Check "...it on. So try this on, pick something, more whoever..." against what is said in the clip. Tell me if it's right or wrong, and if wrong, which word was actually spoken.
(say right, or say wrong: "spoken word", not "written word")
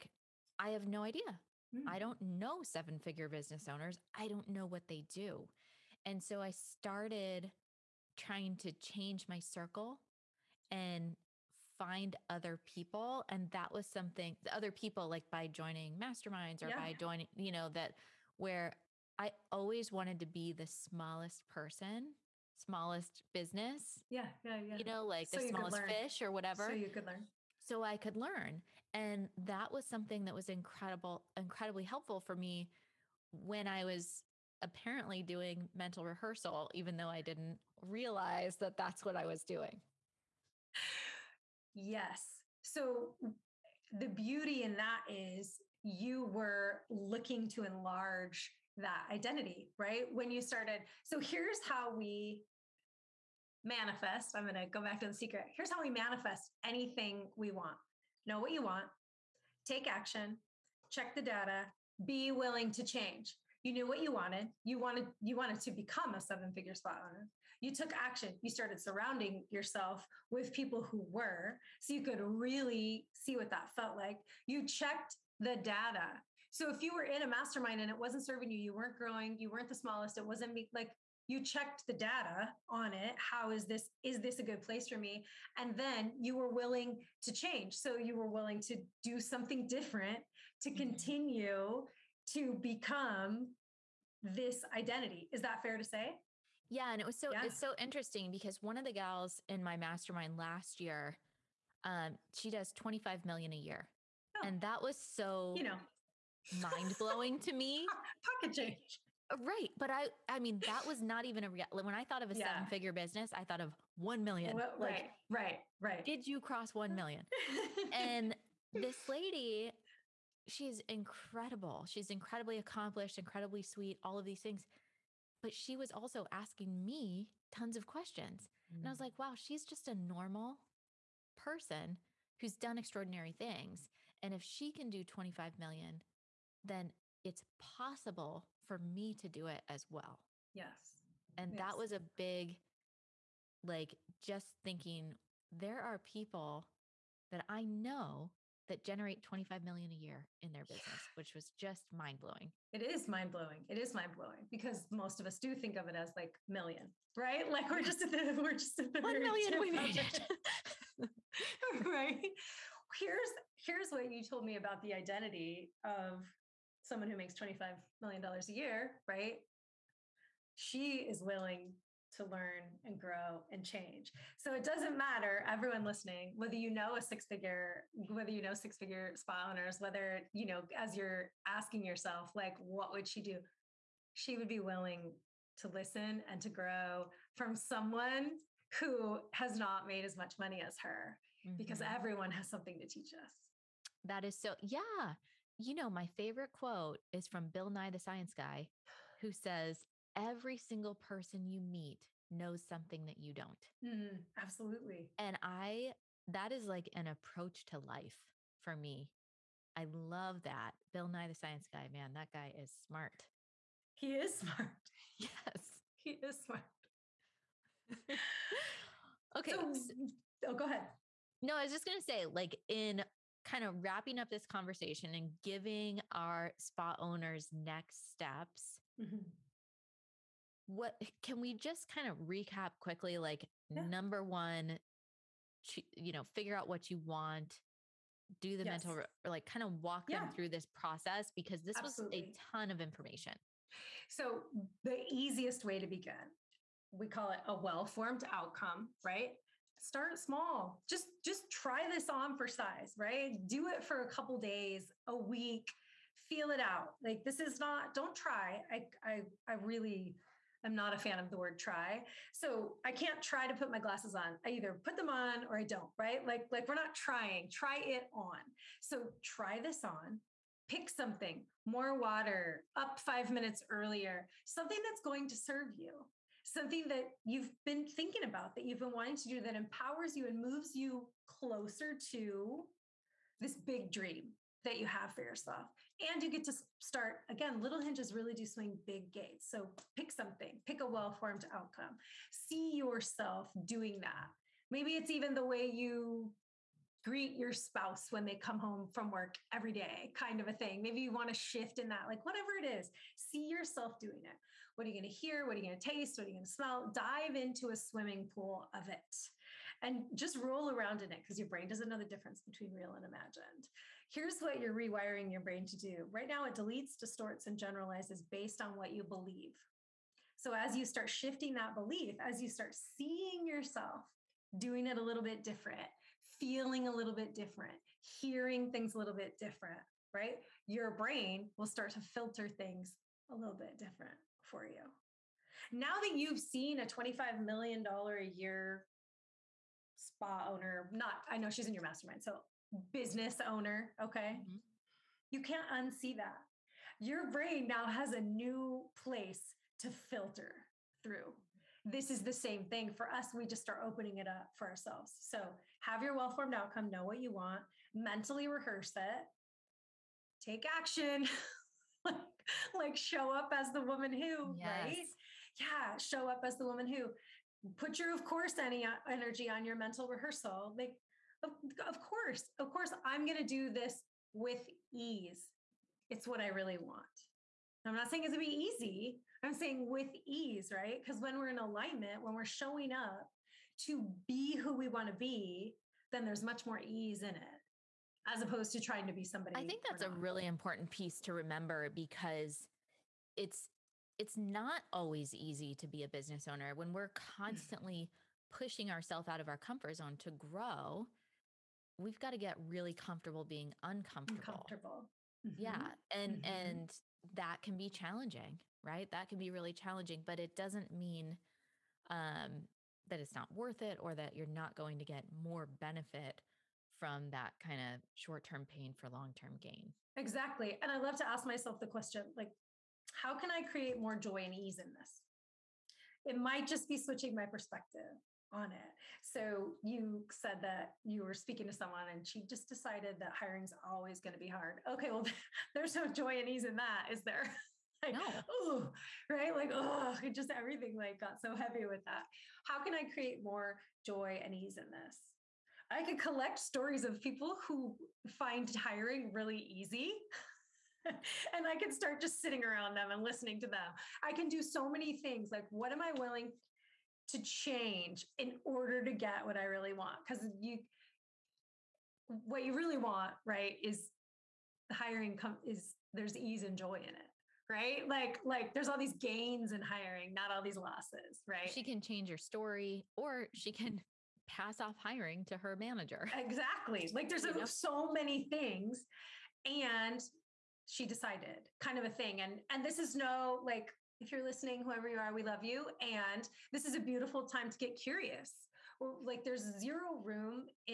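wrong: "water", not "whoever".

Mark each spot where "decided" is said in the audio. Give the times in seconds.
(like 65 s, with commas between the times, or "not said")
432 s, 481 s.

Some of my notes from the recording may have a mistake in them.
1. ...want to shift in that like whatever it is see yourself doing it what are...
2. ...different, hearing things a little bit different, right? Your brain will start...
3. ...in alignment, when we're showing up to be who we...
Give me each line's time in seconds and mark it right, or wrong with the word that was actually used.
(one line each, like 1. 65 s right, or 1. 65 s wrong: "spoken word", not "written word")
1. 301 s right
2. 327 s right
3. 381 s right.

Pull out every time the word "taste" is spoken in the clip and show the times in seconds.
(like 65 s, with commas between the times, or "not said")
305 s.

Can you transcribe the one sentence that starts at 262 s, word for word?
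So I can't try to put my glasses on.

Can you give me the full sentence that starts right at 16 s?
by joining, you know, that where I always wanted to be the smallest person, smallest business.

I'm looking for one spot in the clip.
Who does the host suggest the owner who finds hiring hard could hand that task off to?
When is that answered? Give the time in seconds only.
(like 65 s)
475 s.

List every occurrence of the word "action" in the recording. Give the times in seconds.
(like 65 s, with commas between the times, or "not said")
59 s, 67 s, 360 s.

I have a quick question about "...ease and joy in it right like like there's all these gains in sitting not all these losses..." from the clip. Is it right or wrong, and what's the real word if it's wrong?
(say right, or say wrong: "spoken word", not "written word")
wrong: "hiring", not "sitting".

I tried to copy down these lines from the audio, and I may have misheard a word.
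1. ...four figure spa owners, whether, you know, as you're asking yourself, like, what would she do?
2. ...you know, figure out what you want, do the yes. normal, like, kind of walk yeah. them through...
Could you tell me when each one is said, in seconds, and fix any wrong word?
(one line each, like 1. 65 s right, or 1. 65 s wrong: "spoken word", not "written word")
1. 178 s wrong: "six", not "four"
2. 235 s wrong: "mental", not "normal".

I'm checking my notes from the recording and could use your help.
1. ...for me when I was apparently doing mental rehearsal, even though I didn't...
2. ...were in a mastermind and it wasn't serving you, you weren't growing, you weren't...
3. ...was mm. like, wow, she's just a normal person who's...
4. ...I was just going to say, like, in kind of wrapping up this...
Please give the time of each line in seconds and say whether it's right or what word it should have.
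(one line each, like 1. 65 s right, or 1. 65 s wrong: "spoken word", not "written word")
1. 32 s right
2. 76 s right
3. 128 s right
4. 221 s right.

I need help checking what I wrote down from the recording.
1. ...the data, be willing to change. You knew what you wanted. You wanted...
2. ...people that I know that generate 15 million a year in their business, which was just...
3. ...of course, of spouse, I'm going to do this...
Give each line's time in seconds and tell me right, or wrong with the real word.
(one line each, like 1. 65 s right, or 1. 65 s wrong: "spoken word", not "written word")
1. 61 s right
2. 145 s wrong: "25", not "15"
3. 371 s wrong: "course", not "spouse".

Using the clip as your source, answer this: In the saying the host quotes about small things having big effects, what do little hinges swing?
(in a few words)
big gates.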